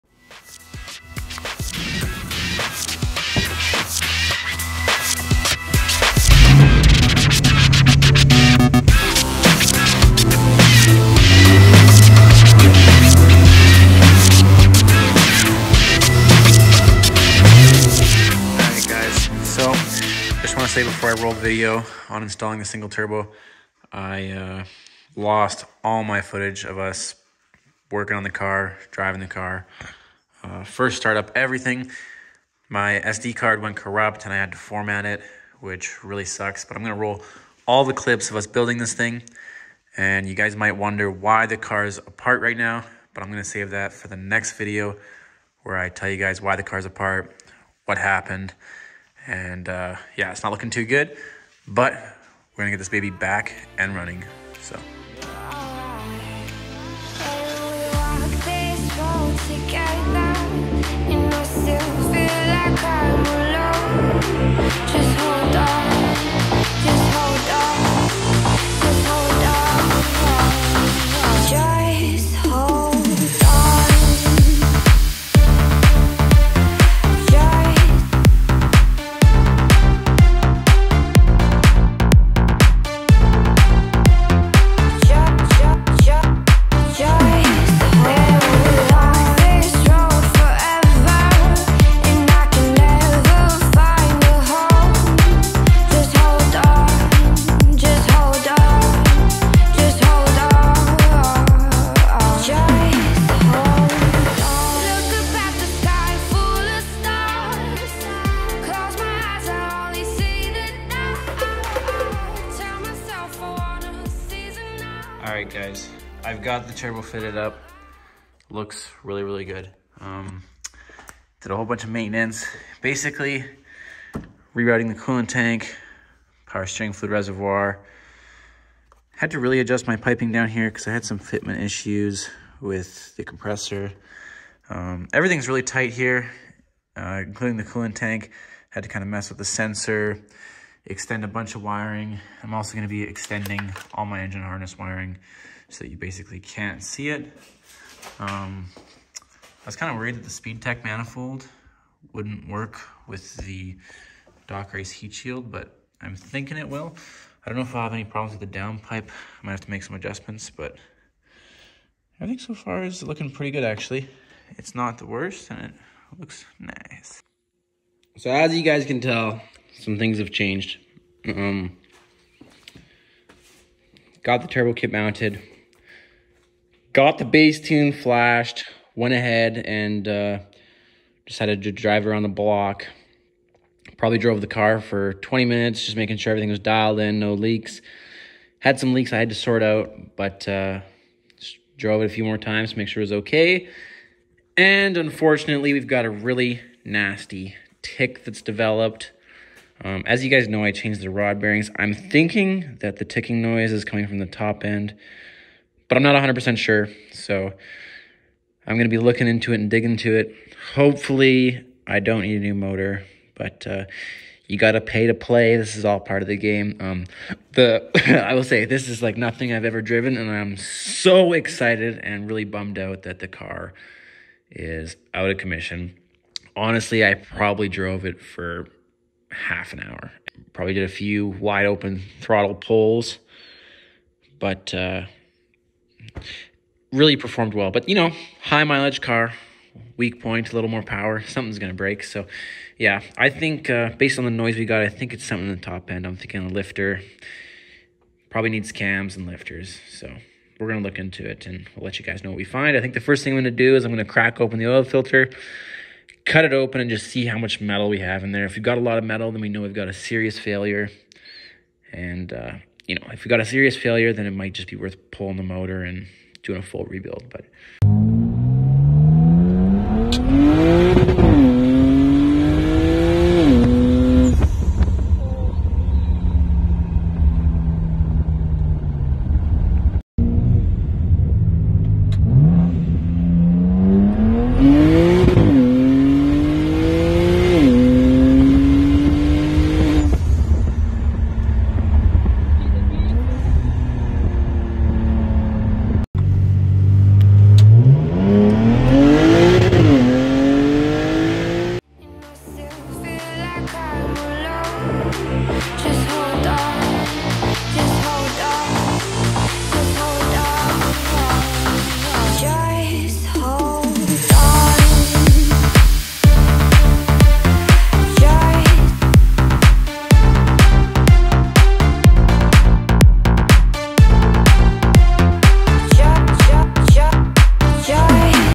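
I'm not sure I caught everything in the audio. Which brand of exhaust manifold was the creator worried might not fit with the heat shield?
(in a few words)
SpeedTech.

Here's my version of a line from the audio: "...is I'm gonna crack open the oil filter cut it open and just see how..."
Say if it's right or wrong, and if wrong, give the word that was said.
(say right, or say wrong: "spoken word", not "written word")
right.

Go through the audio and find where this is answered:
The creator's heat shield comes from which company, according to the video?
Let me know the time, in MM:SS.
02:34.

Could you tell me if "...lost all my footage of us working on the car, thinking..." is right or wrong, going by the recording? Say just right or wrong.
wrong.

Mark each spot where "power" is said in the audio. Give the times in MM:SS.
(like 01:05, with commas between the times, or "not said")
02:06, 04:00.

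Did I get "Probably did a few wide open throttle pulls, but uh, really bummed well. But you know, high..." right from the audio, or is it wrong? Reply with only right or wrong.
wrong.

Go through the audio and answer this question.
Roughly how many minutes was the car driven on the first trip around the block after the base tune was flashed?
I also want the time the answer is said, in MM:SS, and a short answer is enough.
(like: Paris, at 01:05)
20, at 03:05.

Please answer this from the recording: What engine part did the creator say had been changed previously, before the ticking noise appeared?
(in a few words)
rod bearings.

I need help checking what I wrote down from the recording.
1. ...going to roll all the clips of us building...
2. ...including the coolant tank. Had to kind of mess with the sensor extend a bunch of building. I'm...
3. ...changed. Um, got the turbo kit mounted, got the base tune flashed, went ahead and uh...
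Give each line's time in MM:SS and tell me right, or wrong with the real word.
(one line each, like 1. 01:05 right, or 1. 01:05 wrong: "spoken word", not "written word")
1. 00:36 right
2. 02:17 wrong: "wiring", not "building"
3. 02:50 right.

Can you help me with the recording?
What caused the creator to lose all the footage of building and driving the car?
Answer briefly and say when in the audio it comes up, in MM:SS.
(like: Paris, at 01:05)
SD card went corrupt, at 00:33.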